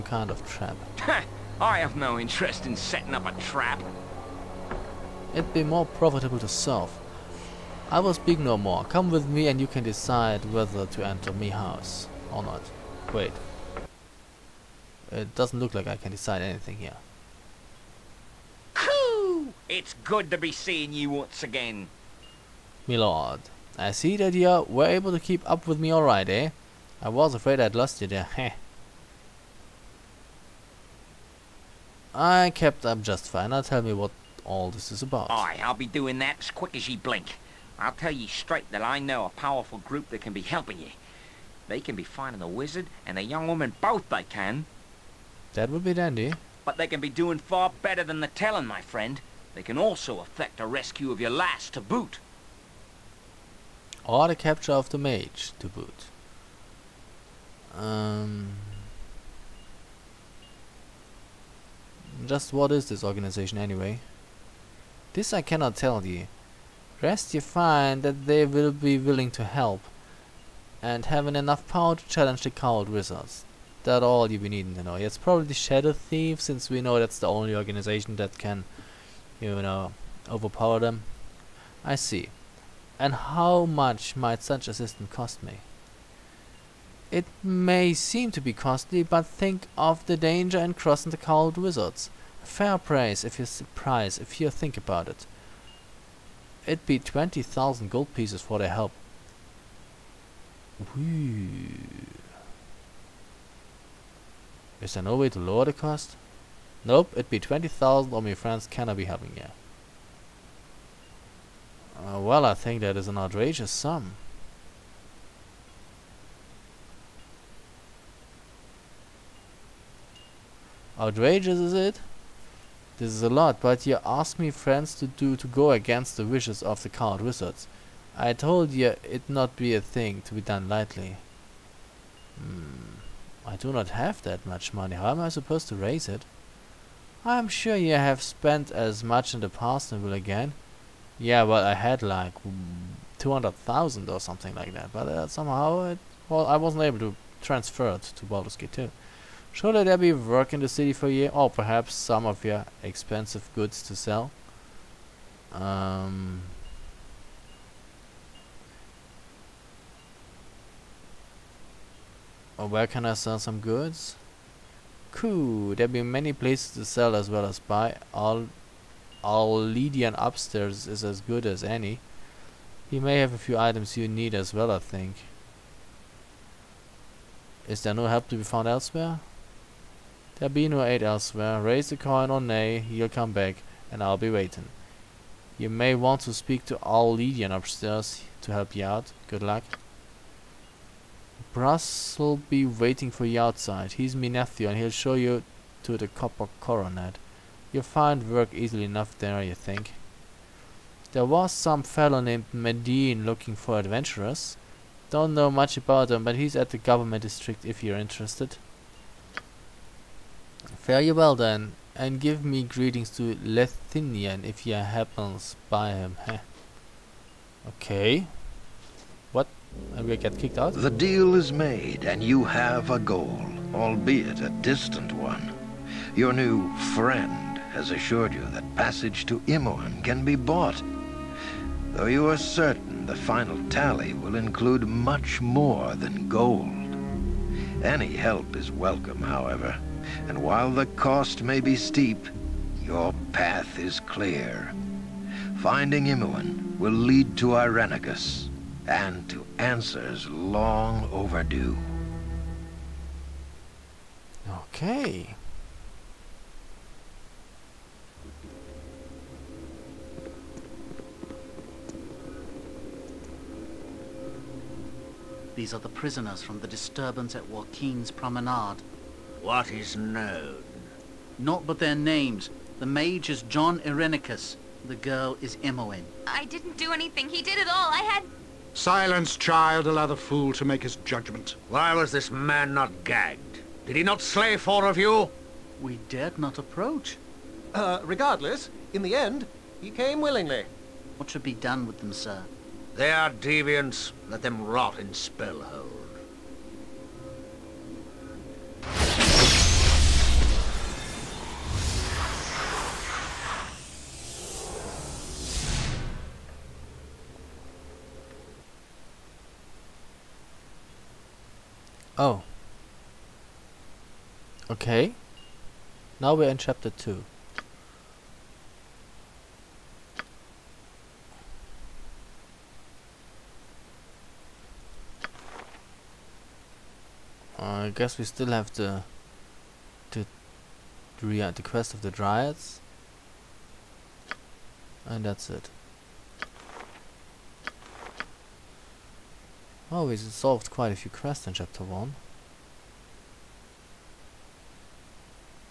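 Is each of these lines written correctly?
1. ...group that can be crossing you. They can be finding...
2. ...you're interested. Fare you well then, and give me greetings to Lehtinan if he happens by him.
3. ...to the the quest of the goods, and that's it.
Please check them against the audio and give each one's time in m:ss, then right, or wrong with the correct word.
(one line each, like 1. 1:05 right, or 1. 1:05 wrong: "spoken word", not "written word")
1. 0:39 wrong: "helping", not "crossing"
2. 3:27 right
3. 5:28 wrong: "dryads", not "goods".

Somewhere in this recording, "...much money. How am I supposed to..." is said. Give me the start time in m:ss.
2:14.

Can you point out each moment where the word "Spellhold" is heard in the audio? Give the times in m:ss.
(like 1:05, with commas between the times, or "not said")
4:55.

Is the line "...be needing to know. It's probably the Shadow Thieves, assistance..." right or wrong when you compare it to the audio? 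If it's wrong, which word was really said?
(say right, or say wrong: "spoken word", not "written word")
wrong: "since", not "assistance".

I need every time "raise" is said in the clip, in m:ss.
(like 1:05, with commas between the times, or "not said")
2:15, 3:01.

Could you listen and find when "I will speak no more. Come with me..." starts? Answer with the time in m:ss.
0:07.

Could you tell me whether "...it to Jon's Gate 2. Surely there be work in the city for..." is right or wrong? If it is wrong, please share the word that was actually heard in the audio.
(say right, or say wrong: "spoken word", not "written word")
wrong: "Baldur", not "Jon".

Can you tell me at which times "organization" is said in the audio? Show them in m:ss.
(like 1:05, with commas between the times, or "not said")
1:03, 1:17.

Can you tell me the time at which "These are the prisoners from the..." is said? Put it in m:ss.
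4:25.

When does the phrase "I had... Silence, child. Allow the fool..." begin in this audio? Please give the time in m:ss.
4:37.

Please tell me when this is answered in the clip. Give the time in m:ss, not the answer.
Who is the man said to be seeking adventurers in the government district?
3:22.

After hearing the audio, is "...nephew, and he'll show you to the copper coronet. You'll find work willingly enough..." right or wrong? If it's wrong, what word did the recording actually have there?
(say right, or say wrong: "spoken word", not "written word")
wrong: "easily", not "willingly".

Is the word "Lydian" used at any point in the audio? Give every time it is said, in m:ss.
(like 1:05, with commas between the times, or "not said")
2:49, 3:07.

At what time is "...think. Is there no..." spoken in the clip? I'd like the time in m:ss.
2:54.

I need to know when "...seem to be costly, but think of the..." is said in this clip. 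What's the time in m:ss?
1:27.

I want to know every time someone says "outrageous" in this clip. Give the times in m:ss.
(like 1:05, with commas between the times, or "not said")
1:53, 2:00.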